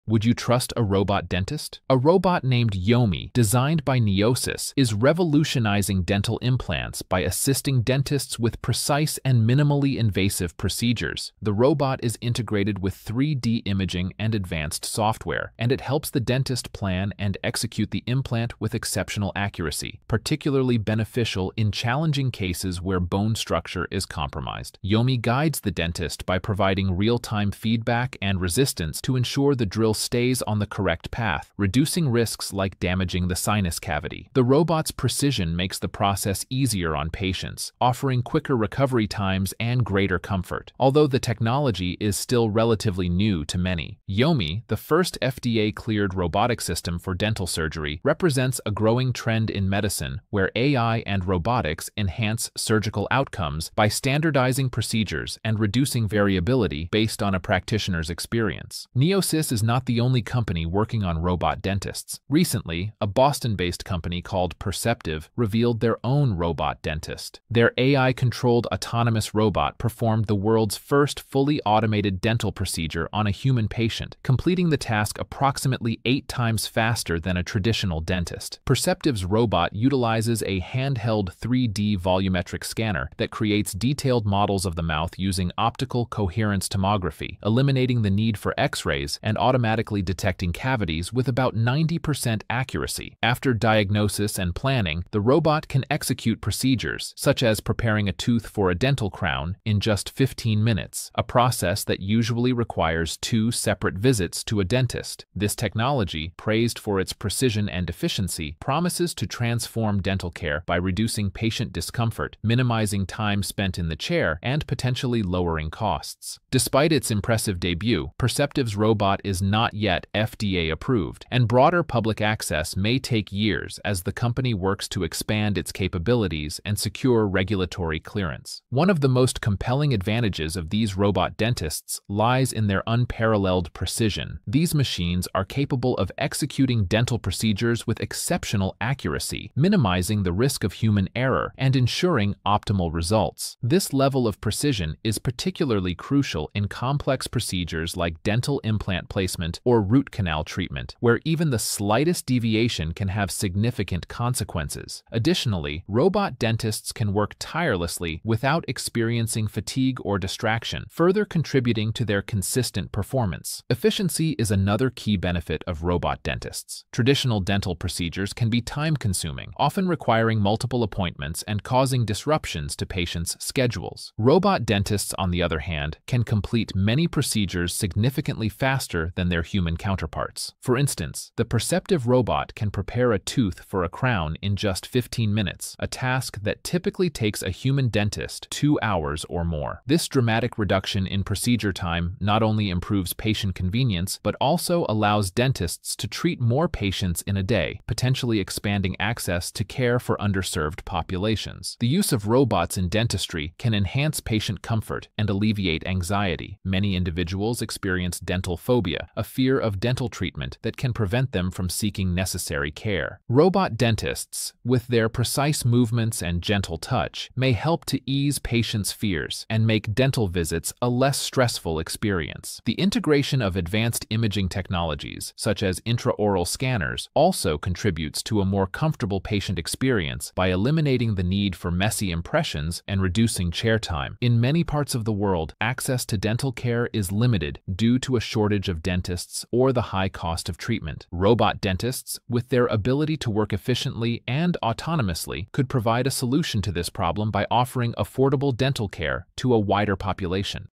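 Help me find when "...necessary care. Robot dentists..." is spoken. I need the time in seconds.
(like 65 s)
212 s.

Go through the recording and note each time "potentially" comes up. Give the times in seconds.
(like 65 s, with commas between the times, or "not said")
114 s, 197 s.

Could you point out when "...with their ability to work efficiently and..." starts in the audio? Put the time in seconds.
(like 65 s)
242 s.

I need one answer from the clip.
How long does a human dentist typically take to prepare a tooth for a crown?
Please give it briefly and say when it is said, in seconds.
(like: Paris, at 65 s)
2 hours or more, at 188 s.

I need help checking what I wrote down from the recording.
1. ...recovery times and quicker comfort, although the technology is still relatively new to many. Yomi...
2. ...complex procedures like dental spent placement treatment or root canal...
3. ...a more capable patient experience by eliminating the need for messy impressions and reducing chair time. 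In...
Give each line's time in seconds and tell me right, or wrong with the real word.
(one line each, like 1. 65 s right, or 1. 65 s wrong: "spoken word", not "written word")
1. 38 s wrong: "greater", not "quicker"
2. 146 s wrong: "implant", not "spent"
3. 228 s wrong: "comfortable", not "capable".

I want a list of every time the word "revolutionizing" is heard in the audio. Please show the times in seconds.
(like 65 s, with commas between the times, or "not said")
4 s.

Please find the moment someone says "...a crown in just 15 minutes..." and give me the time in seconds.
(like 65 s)
183 s.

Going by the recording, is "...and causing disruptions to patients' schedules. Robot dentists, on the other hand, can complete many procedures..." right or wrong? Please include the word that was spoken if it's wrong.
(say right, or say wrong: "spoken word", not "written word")
right.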